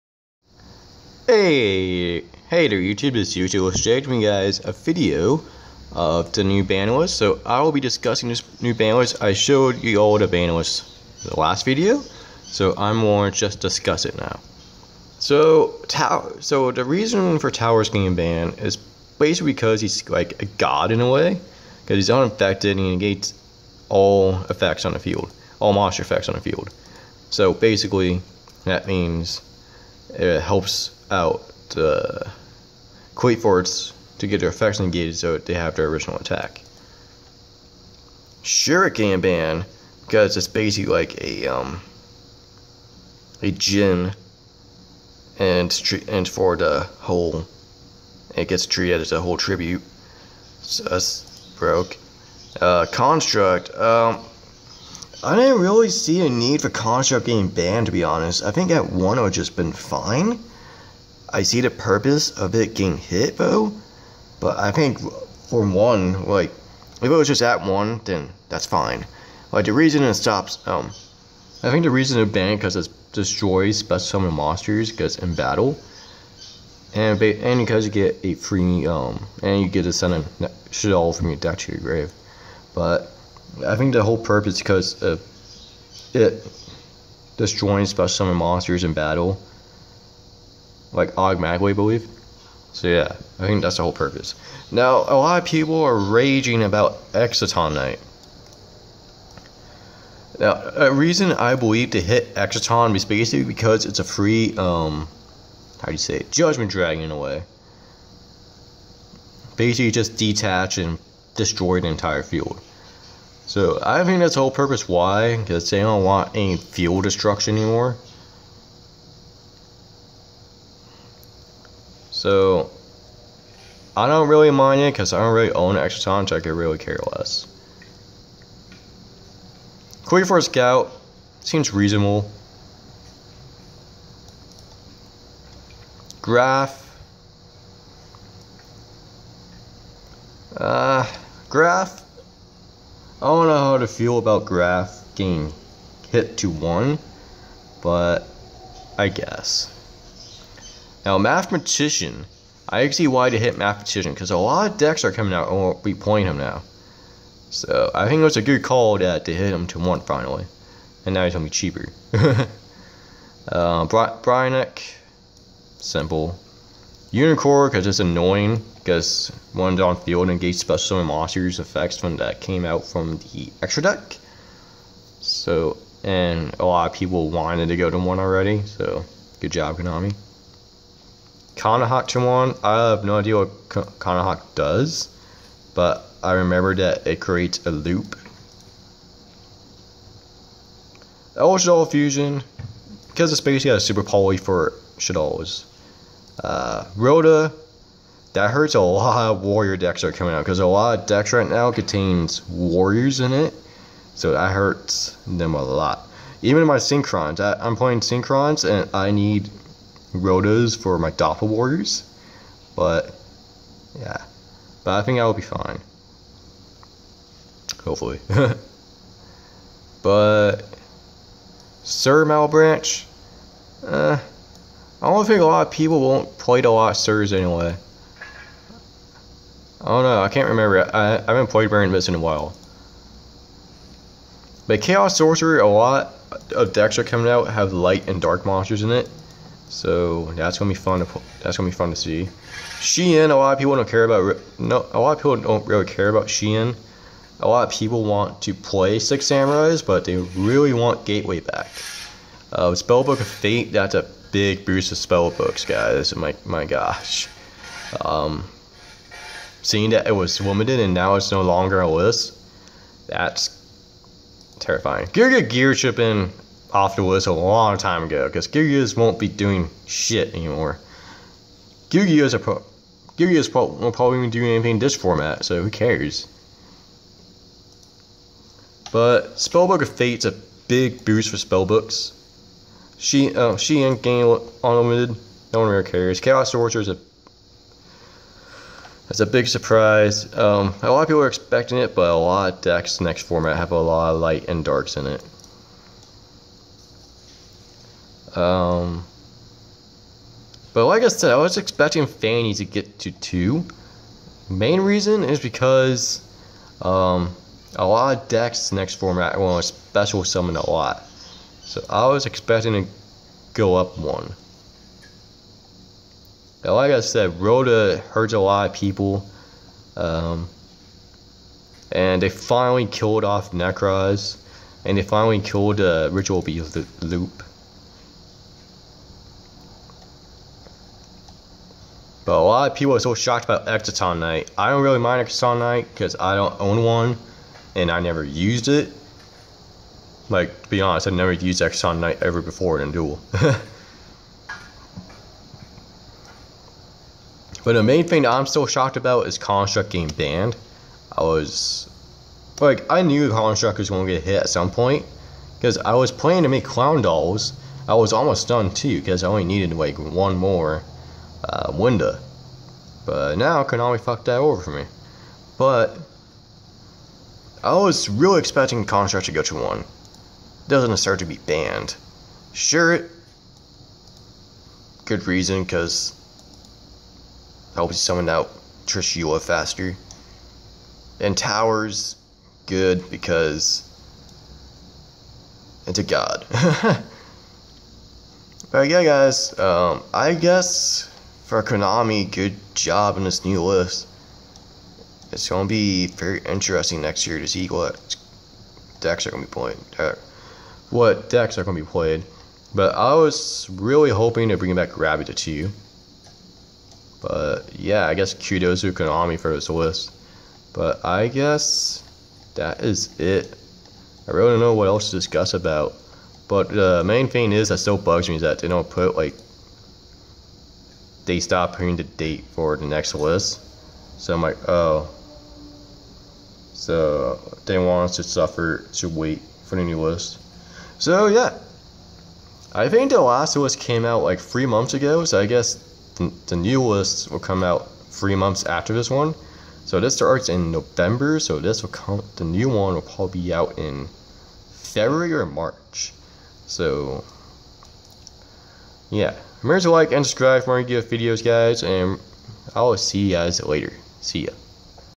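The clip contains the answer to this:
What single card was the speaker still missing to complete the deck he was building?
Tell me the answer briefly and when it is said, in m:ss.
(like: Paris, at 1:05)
Winda, at 6:01.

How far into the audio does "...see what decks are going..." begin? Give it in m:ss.
6:37.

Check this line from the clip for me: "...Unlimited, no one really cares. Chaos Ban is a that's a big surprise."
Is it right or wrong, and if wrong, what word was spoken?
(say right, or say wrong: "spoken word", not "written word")
wrong: "Sorcerer", not "Ban".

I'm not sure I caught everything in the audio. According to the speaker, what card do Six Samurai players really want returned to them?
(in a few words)
Gateway.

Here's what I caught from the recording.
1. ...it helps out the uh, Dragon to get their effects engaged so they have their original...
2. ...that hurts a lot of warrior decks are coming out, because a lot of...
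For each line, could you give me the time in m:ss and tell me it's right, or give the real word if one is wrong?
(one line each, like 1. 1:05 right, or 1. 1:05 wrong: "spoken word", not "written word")
1. 0:30 wrong: "Forts", not "Dragon"
2. 3:18 right.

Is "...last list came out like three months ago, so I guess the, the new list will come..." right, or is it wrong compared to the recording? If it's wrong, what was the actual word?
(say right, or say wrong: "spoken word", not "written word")
right.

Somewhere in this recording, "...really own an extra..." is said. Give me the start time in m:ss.
2:05.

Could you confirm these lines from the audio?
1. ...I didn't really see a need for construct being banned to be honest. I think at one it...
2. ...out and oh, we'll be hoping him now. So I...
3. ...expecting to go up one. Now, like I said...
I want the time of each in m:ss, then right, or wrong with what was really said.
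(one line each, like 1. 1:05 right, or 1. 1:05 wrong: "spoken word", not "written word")
1. 0:55 right
2. 2:35 wrong: "playing", not "hoping"
3. 5:12 right.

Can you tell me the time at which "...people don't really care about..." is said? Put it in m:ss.
4:05.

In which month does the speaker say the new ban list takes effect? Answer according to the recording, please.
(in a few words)
November.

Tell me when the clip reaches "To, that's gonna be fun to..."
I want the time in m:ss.
4:00.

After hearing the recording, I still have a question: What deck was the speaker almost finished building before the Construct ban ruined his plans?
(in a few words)
Clown Dolls.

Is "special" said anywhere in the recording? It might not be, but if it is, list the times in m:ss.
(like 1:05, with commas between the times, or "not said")
1:13, 1:27, 2:50, 5:09.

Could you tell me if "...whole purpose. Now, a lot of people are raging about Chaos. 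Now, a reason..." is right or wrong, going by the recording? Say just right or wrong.
wrong.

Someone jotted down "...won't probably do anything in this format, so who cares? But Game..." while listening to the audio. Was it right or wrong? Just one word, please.
wrong.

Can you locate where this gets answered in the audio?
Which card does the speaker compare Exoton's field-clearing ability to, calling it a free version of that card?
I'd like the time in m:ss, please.
1:46.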